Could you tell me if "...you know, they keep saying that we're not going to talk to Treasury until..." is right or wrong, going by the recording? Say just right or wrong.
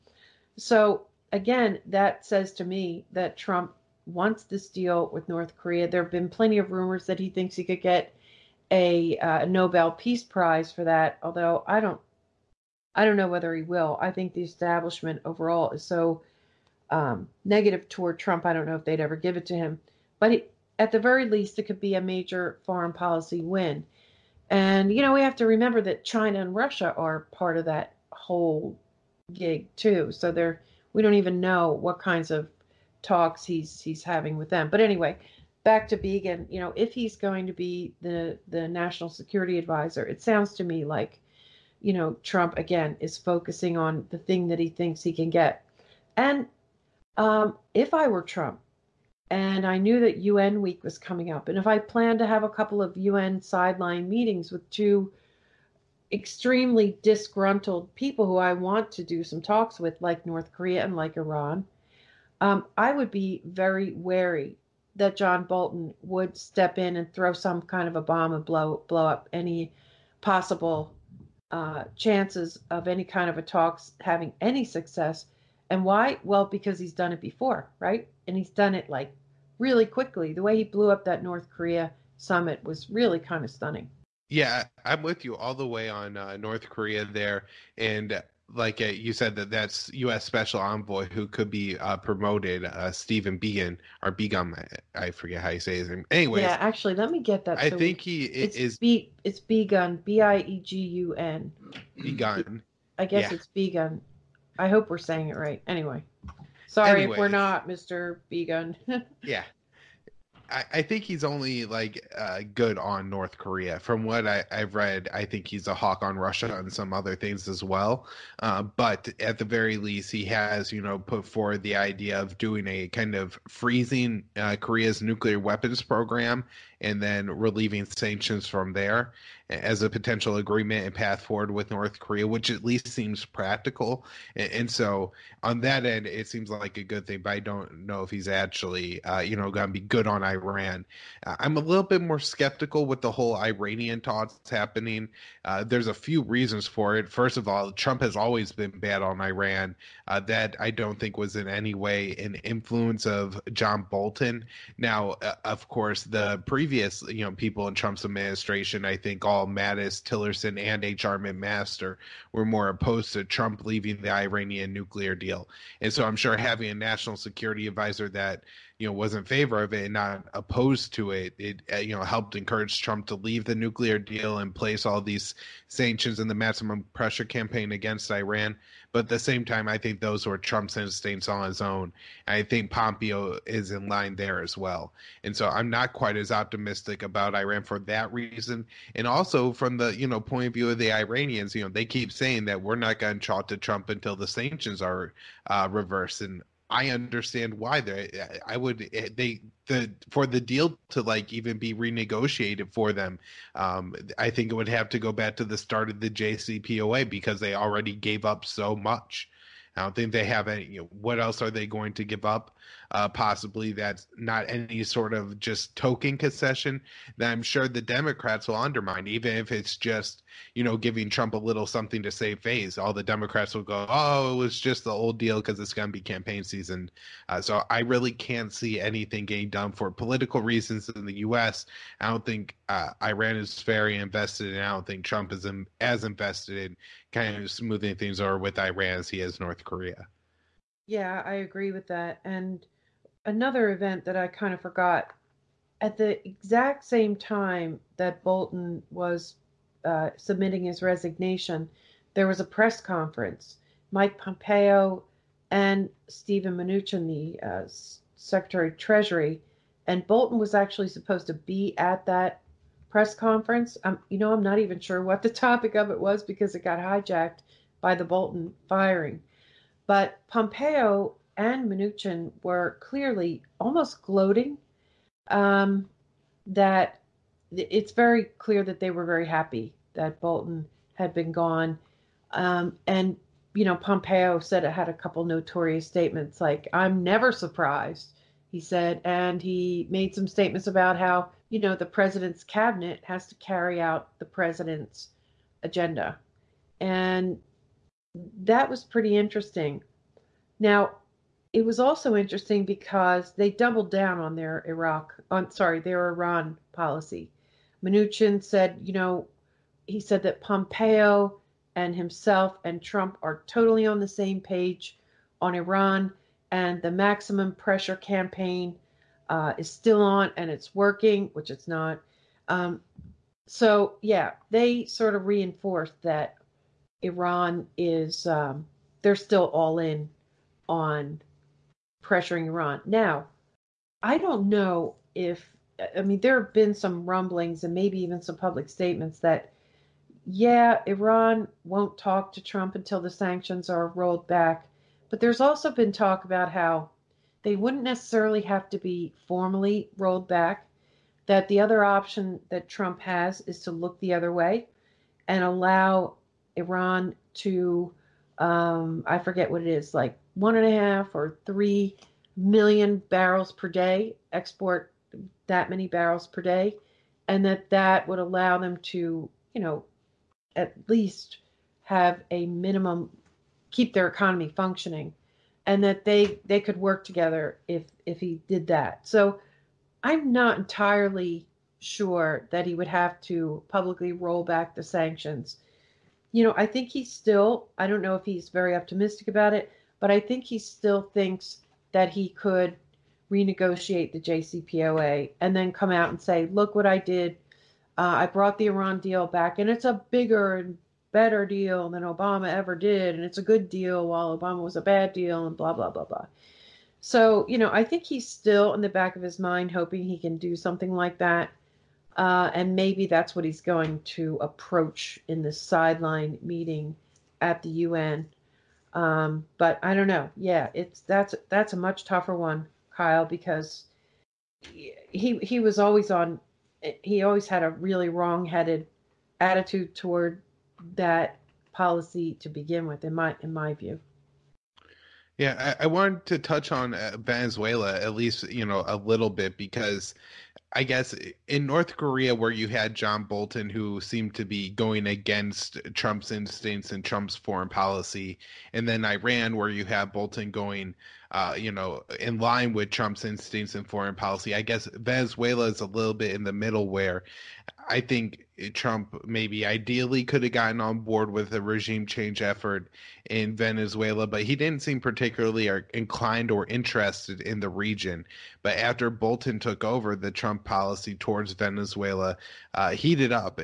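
wrong.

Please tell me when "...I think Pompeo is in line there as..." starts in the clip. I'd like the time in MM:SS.
03:02.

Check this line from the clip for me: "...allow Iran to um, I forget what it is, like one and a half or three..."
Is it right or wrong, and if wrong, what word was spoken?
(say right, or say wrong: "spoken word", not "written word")
right.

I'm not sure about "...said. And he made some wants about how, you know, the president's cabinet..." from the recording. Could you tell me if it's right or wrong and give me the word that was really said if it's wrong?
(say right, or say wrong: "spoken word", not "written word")
wrong: "statements", not "wants".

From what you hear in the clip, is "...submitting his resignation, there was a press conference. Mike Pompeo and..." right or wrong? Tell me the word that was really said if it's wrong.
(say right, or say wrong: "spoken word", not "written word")
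right.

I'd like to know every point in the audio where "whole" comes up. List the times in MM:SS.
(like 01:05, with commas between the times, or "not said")
00:28, 02:23.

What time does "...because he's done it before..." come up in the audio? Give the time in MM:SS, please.
01:16.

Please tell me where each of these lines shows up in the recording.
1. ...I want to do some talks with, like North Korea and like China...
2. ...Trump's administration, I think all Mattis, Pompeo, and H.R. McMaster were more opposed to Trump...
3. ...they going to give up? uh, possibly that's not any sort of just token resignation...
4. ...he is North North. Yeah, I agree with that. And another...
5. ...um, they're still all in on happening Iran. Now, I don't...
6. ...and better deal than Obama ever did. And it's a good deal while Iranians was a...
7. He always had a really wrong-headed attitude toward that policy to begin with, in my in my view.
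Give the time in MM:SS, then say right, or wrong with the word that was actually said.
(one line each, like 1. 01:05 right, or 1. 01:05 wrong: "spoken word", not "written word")
1. 00:58 wrong: "Iran", not "China"
2. 02:37 wrong: "Tillerson", not "Pompeo"
3. 03:31 wrong: "concession", not "resignation"
4. 03:59 wrong: "Korea", not "North"
5. 05:28 wrong: "pressuring", not "happening"
6. 06:40 wrong: "Obama", not "Iranians"
7. 07:07 right.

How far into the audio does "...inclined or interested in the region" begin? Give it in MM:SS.
07:45.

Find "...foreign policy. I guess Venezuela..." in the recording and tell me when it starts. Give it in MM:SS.
07:33.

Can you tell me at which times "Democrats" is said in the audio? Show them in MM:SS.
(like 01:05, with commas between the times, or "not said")
03:37, 03:43.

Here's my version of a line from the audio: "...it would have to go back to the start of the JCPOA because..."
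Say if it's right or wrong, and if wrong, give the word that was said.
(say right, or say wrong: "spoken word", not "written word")
right.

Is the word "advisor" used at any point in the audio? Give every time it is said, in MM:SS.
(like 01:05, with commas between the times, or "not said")
00:39, 02:47.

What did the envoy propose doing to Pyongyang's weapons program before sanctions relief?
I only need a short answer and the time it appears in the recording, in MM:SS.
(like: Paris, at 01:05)
freezing, at 02:03.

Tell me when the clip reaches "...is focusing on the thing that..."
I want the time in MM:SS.
00:42.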